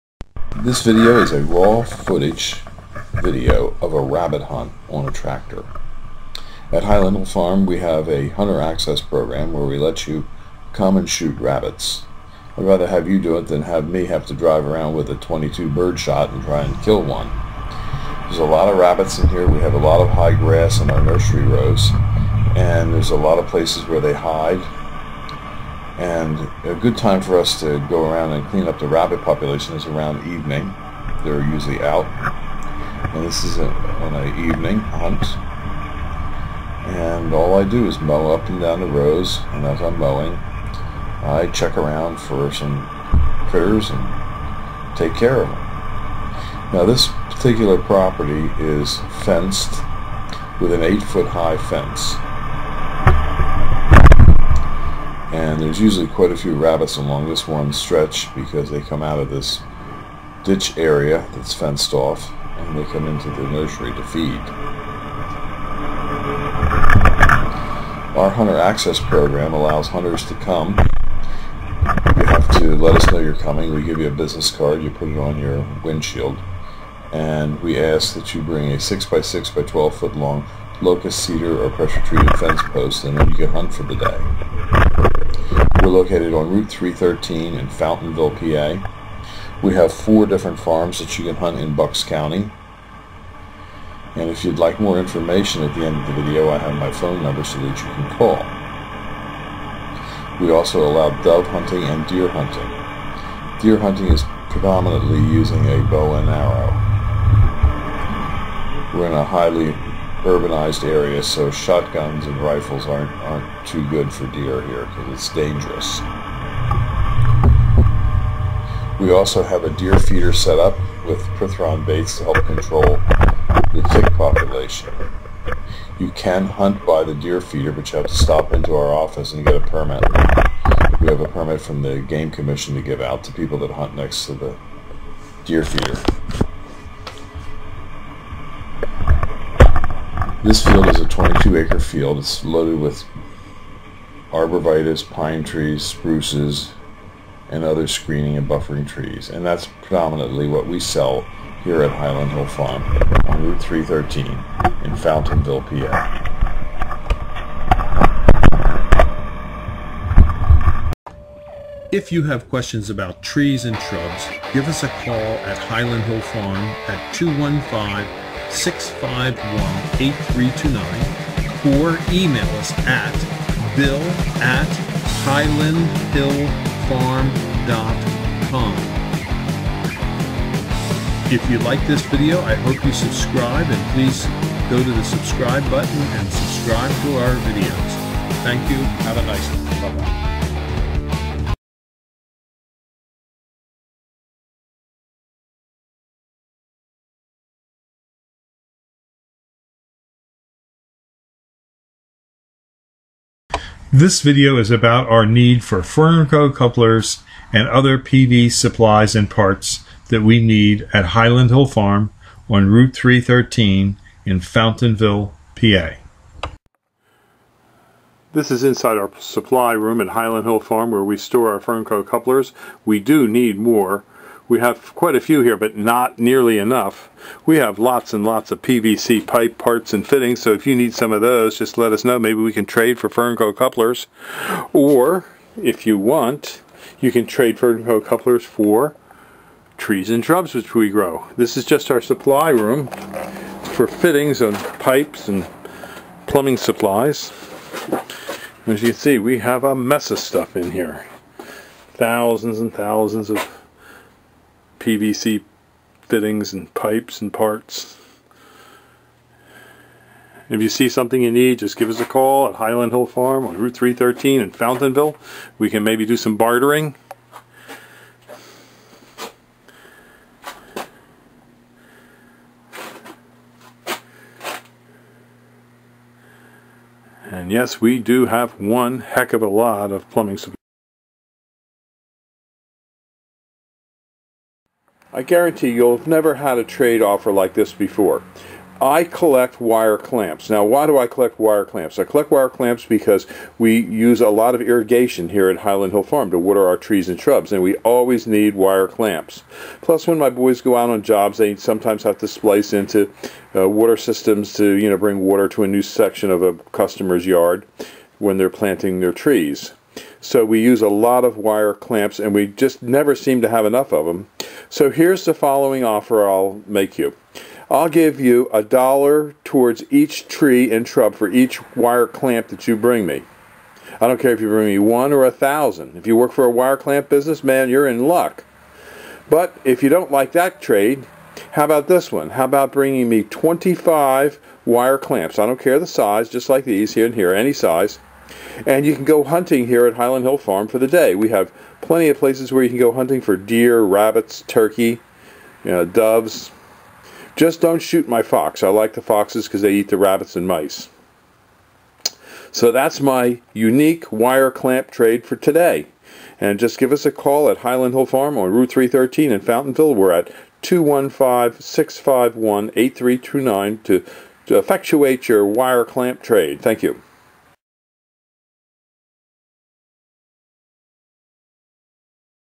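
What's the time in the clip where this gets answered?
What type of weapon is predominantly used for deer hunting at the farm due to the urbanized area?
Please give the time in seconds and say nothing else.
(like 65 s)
105 s.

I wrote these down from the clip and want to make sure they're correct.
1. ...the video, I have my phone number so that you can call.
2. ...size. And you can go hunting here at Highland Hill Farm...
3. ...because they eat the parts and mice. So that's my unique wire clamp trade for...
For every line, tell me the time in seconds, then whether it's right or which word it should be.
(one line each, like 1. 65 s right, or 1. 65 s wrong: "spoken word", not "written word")
1. 96 s right
2. 337 s right
3. 349 s wrong: "rabbits", not "parts".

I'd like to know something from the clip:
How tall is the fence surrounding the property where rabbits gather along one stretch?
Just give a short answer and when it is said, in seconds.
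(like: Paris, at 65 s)
8 foot, at 50 s.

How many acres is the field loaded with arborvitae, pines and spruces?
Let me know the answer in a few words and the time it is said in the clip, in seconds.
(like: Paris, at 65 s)
22 acre, at 141 s.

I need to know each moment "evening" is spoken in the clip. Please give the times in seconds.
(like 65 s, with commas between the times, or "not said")
30 s, 34 s.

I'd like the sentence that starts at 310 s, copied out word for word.
So we use a lot of wire clamps, and we just never seem to have enough of them.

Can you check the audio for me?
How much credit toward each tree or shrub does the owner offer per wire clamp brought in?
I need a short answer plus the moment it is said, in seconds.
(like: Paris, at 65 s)
a dollar, at 318 s.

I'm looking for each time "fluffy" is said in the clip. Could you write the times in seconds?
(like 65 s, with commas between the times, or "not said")
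not said.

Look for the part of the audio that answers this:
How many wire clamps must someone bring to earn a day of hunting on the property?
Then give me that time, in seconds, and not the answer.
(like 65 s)
333 s.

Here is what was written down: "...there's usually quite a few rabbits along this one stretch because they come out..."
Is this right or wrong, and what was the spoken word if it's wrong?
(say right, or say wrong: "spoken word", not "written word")
right.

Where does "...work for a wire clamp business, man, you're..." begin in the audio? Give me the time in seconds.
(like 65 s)
326 s.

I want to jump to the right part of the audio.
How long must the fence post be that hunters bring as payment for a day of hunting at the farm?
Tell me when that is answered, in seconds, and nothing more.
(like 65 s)
79 s.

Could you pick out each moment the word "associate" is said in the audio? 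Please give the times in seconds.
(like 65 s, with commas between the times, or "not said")
not said.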